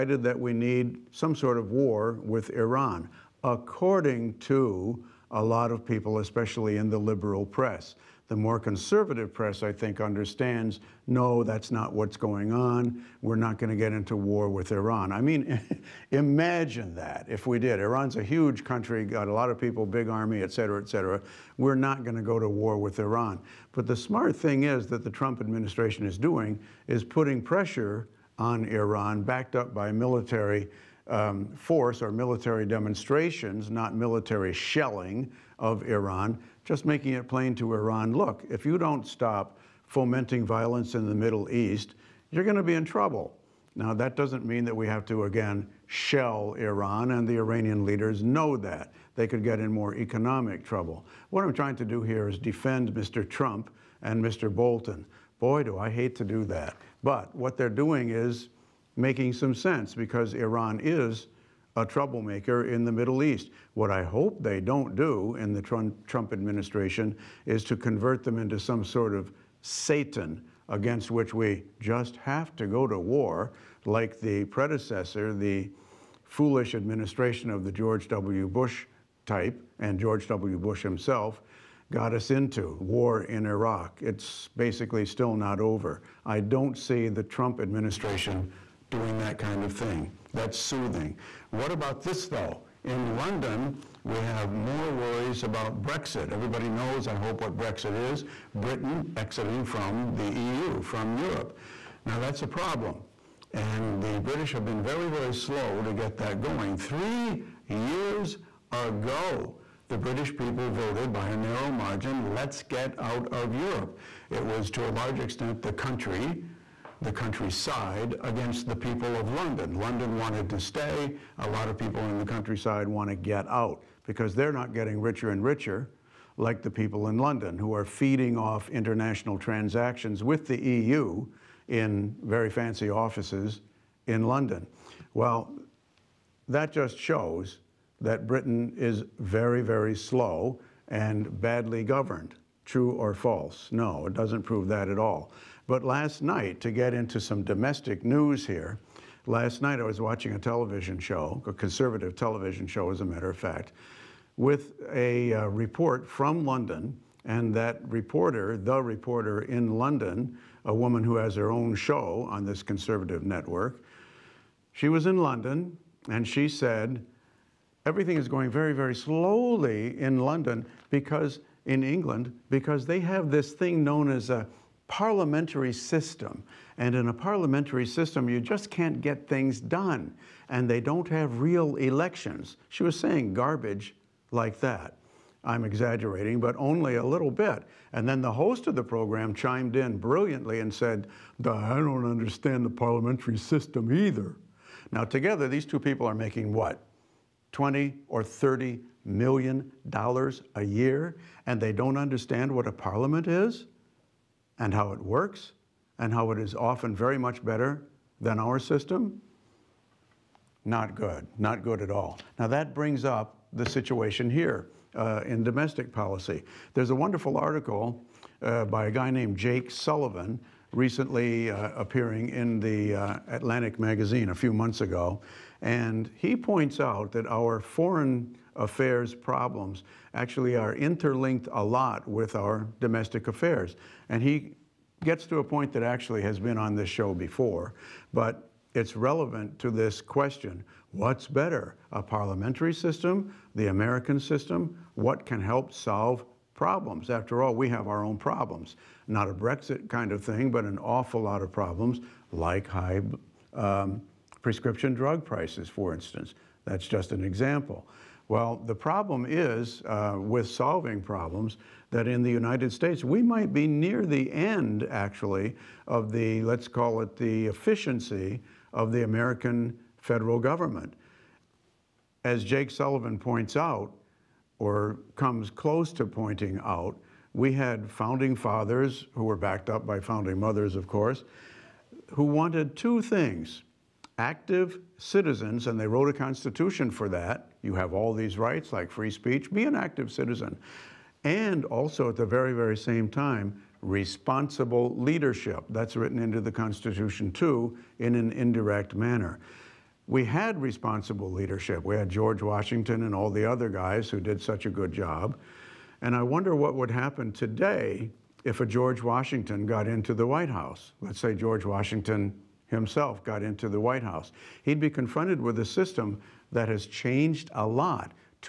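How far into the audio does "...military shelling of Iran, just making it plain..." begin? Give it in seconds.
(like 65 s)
33 s.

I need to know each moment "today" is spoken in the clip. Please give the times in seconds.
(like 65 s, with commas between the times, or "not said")
307 s.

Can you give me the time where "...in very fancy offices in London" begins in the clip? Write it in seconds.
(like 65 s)
131 s.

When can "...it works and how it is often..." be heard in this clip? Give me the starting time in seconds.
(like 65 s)
204 s.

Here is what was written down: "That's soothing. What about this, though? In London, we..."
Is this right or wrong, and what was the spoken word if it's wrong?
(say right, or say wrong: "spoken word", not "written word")
right.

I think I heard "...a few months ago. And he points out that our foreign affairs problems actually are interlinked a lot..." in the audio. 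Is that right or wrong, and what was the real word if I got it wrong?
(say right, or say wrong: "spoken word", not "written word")
right.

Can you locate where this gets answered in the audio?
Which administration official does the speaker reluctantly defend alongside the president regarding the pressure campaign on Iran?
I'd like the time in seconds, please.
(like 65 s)
54 s.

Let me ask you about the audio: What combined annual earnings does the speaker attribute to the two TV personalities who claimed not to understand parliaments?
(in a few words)
20 or 30 million dollars.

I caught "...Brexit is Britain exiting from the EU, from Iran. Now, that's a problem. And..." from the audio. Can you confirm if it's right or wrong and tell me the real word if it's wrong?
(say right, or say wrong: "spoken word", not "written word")
wrong: "Europe", not "Iran".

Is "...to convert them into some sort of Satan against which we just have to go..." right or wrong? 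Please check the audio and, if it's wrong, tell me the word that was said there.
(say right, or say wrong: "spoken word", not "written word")
right.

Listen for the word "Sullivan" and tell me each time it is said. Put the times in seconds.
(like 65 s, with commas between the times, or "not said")
219 s, 272 s.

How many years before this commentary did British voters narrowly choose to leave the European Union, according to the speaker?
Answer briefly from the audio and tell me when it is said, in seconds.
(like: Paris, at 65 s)
3, at 106 s.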